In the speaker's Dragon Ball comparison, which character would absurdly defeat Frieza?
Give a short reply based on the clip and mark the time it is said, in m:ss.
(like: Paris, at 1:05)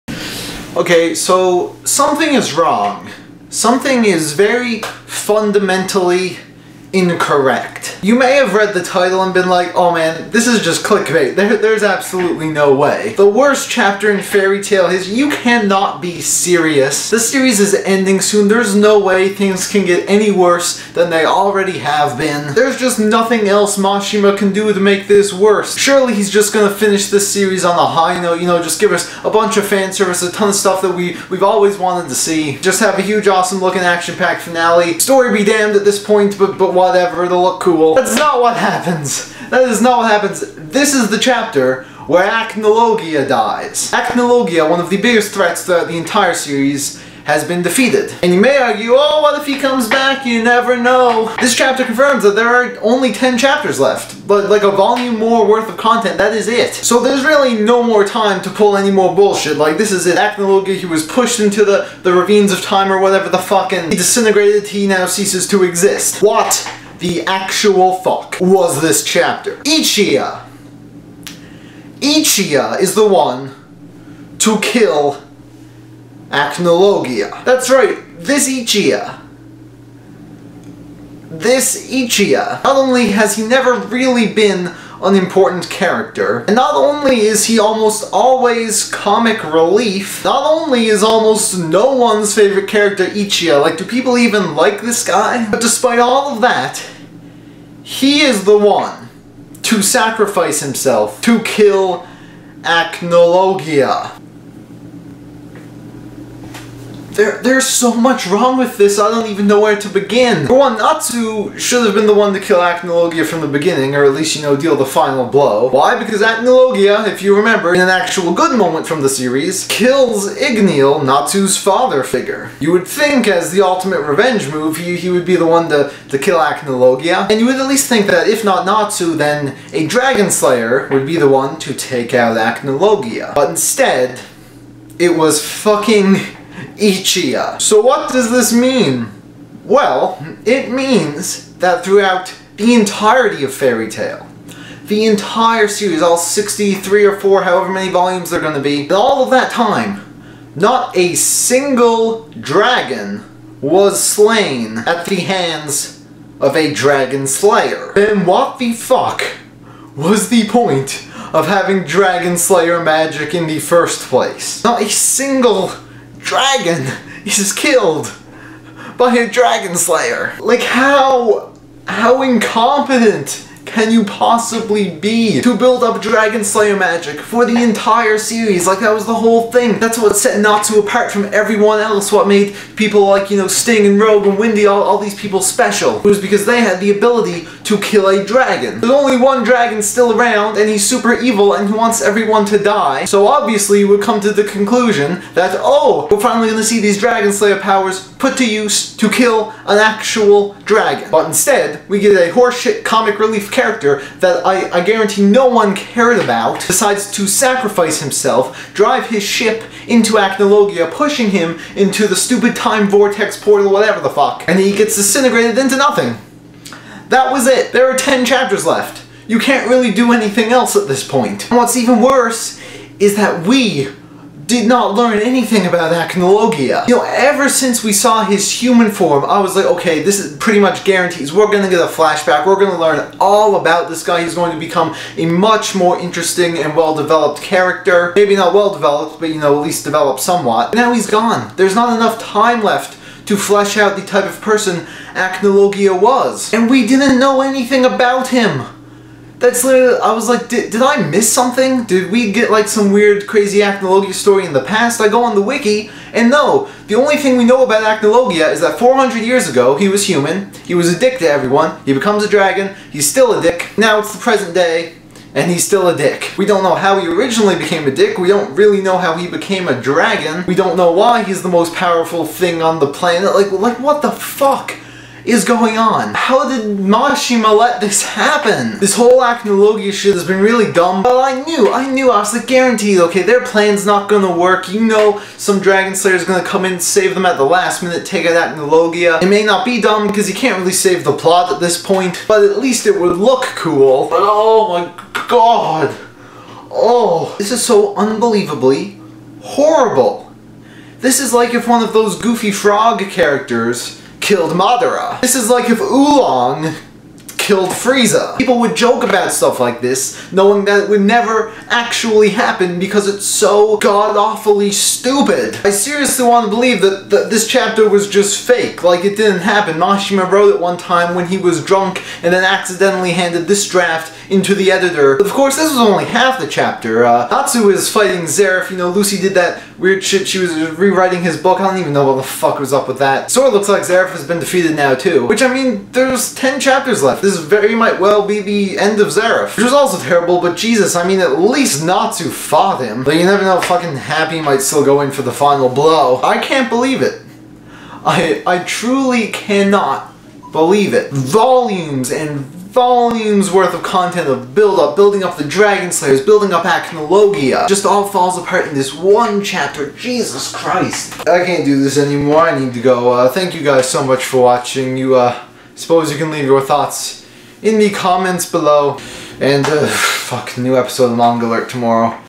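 Oolong, at 5:05.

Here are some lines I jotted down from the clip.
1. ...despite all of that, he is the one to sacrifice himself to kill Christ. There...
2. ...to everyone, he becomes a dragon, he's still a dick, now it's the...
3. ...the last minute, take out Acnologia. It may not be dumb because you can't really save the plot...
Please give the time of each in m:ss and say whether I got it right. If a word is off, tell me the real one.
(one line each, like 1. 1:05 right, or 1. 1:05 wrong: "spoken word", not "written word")
1. 1:35 wrong: "Acnologia", not "Christ"
2. 4:21 right
3. 4:47 right.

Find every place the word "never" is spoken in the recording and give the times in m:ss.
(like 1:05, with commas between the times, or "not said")
0:50, 1:23, 5:11, 5:43.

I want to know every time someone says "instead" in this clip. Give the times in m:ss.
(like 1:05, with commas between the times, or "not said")
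2:13, 3:21.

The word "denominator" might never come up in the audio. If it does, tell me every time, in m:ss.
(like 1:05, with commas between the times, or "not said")
not said.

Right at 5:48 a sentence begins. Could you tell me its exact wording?
I, I truly cannot believe it.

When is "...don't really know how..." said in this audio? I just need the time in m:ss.
4:28.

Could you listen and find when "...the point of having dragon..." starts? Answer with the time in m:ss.
2:40.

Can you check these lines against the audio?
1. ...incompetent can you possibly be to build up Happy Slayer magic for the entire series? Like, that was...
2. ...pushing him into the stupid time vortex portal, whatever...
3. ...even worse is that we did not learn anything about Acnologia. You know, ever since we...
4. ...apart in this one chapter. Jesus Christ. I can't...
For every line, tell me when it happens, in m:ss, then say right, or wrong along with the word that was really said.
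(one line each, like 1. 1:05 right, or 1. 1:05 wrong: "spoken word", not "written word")
1. 2:52 wrong: "Dragon", not "Happy"
2. 3:30 right
3. 3:41 right
4. 5:58 right.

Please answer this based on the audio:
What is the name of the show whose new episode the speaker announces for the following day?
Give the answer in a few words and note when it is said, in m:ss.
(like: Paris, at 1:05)
Manga Alert, at 6:11.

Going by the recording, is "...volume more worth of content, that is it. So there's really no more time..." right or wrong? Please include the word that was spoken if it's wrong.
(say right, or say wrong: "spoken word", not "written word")
right.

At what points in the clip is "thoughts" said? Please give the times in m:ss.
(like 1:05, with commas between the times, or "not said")
6:06.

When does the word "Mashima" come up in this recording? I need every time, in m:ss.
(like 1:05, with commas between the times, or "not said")
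0:23, 4:36, 5:19.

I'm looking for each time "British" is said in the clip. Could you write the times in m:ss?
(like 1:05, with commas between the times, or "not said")
not said.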